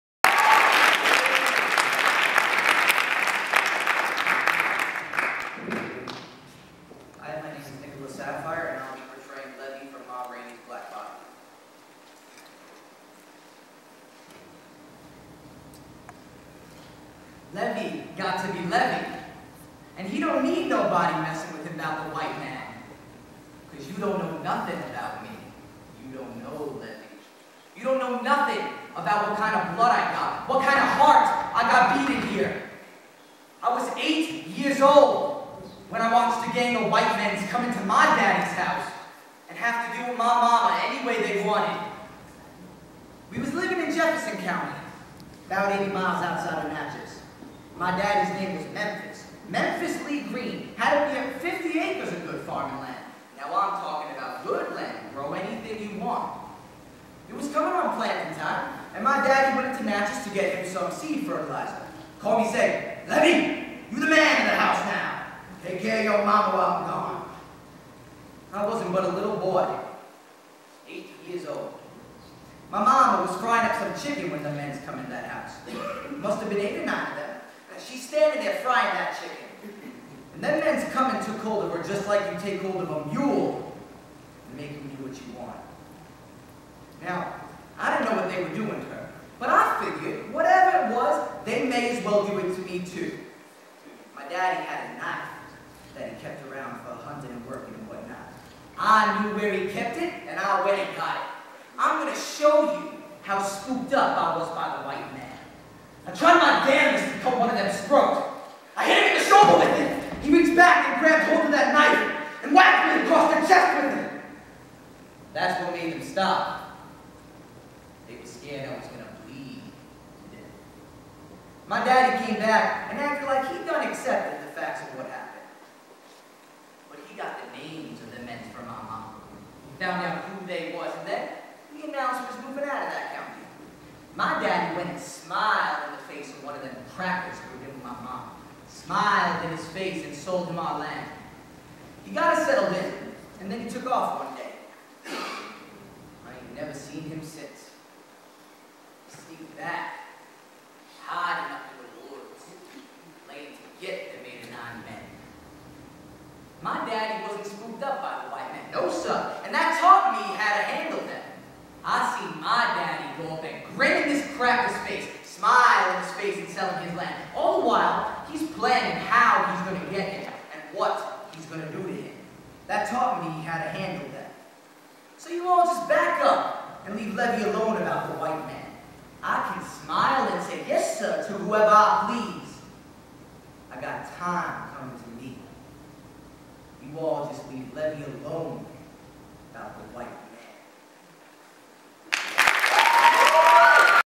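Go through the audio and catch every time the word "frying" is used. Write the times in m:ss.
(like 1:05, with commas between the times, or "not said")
1:13, 1:18.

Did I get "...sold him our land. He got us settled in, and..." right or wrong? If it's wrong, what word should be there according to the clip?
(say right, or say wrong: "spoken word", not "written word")
right.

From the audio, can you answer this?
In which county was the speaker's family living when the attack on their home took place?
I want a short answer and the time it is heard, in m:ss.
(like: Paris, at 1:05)
Jefferson County, at 0:43.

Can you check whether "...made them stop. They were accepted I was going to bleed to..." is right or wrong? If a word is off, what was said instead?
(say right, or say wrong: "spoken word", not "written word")
wrong: "scared", not "accepted".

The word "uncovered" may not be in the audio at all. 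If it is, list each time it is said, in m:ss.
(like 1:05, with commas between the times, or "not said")
not said.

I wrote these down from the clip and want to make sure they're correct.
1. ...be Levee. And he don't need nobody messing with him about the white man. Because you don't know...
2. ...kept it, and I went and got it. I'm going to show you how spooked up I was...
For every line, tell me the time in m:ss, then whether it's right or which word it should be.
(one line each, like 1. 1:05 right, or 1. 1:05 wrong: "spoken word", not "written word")
1. 0:18 right
2. 1:39 right.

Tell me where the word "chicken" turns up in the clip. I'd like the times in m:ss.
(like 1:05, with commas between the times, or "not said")
1:14, 1:19.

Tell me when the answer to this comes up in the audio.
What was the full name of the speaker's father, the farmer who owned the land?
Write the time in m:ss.
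0:49.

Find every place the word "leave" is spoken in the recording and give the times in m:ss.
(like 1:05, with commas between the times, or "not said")
2:56, 3:07.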